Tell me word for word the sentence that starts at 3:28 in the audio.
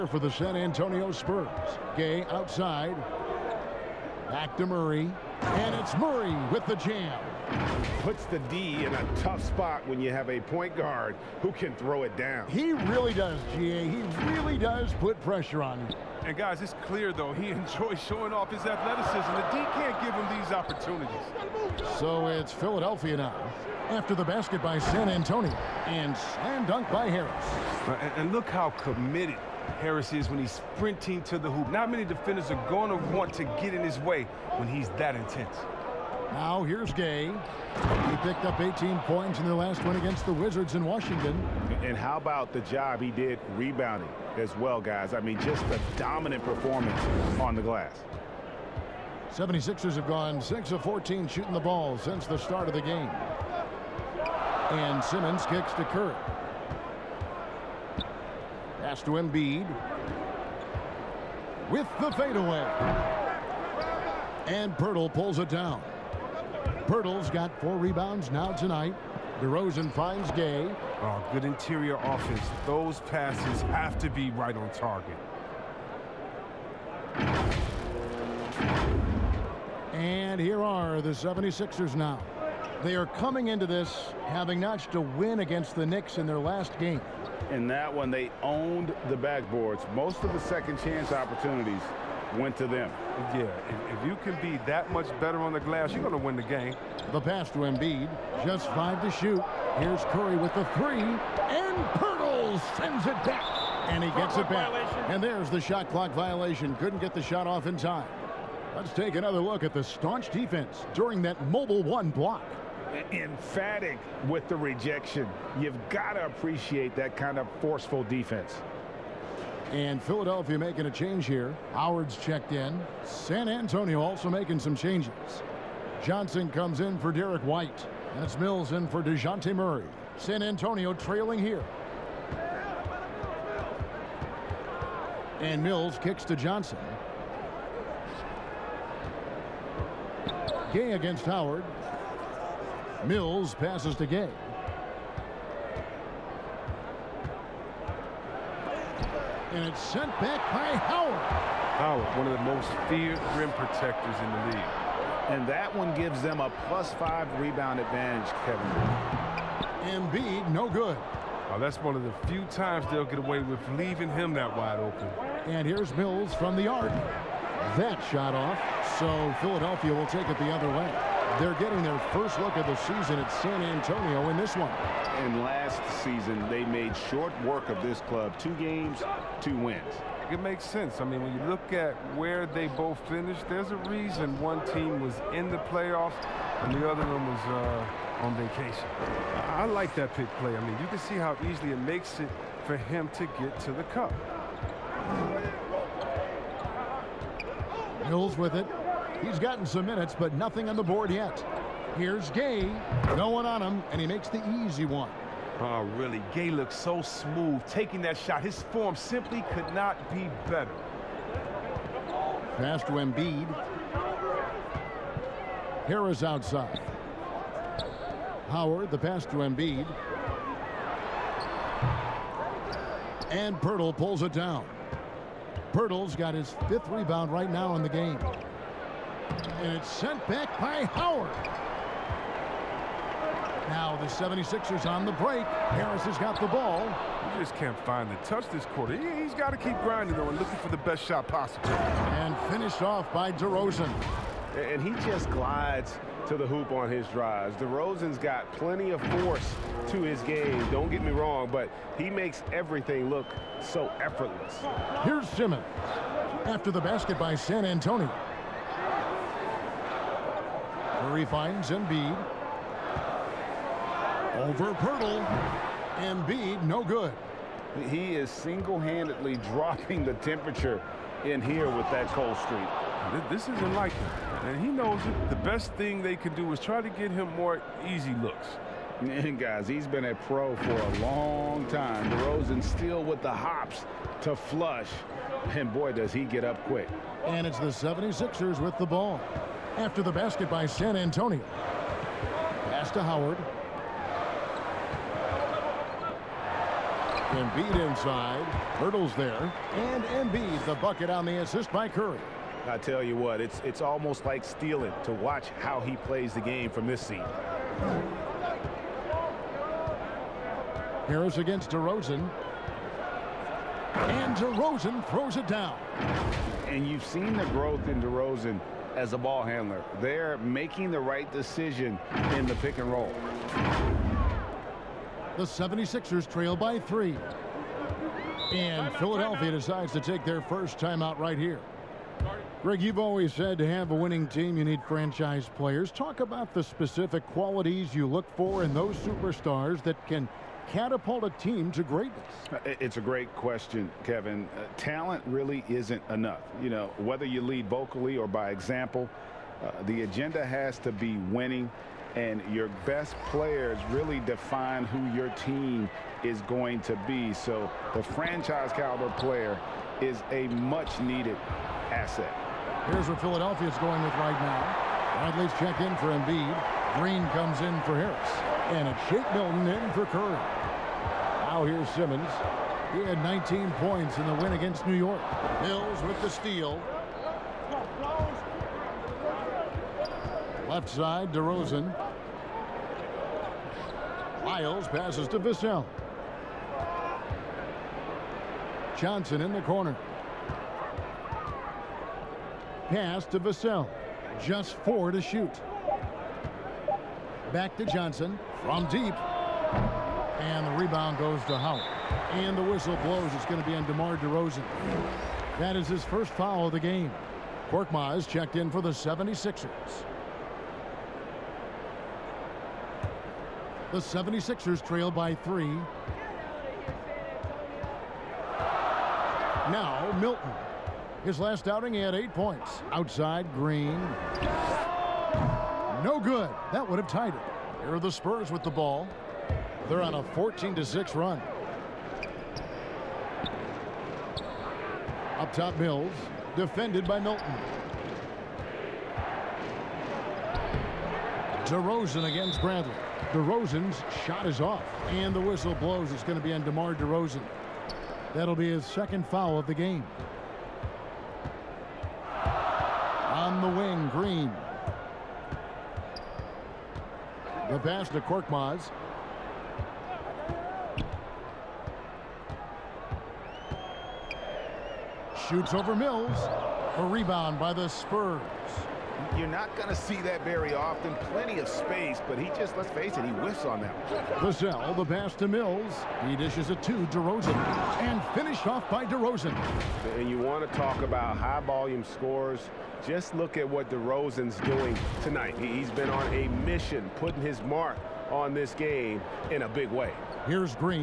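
His form simply could not be better.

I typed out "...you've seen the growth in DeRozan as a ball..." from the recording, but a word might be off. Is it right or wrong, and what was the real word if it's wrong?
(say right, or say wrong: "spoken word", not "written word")
right.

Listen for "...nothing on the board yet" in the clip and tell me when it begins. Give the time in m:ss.
3:20.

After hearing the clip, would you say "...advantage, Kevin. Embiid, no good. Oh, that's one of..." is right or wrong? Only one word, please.
right.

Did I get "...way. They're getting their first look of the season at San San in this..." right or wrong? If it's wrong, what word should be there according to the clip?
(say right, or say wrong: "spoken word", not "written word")
wrong: "Antonio", not "San".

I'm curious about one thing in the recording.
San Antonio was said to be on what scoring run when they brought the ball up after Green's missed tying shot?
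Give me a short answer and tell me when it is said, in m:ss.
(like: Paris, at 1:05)
14 to 6, at 7:10.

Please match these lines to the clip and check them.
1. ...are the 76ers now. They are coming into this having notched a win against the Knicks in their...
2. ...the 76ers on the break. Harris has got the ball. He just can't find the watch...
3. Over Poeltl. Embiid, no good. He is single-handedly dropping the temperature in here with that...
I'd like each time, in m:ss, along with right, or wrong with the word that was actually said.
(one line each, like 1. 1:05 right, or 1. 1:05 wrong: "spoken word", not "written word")
1. 1:20 right
2. 3:53 wrong: "touch", not "watch"
3. 4:24 right.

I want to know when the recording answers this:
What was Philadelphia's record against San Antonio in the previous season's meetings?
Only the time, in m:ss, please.
2:58.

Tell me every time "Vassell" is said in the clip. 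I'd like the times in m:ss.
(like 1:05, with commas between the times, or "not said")
6:25, 6:33.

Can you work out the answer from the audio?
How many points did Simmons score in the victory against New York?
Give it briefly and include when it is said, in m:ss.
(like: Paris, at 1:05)
19, at 6:13.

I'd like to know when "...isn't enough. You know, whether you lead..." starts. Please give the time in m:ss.
5:45.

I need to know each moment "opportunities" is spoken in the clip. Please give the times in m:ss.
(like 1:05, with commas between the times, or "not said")
0:20, 1:31.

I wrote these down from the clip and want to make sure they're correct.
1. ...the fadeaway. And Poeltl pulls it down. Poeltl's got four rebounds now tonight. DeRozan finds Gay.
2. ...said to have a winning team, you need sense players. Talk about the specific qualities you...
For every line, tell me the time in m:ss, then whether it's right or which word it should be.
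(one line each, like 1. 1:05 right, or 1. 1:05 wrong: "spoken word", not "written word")
1. 1:02 right
2. 5:33 wrong: "franchise", not "sense".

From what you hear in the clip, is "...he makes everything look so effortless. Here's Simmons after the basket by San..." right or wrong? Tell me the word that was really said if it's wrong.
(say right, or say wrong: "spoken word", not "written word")
right.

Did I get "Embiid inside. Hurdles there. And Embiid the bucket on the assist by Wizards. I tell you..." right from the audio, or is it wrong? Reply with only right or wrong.
wrong.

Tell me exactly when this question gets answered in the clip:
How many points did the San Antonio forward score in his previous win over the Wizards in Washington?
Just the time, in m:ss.
0:38.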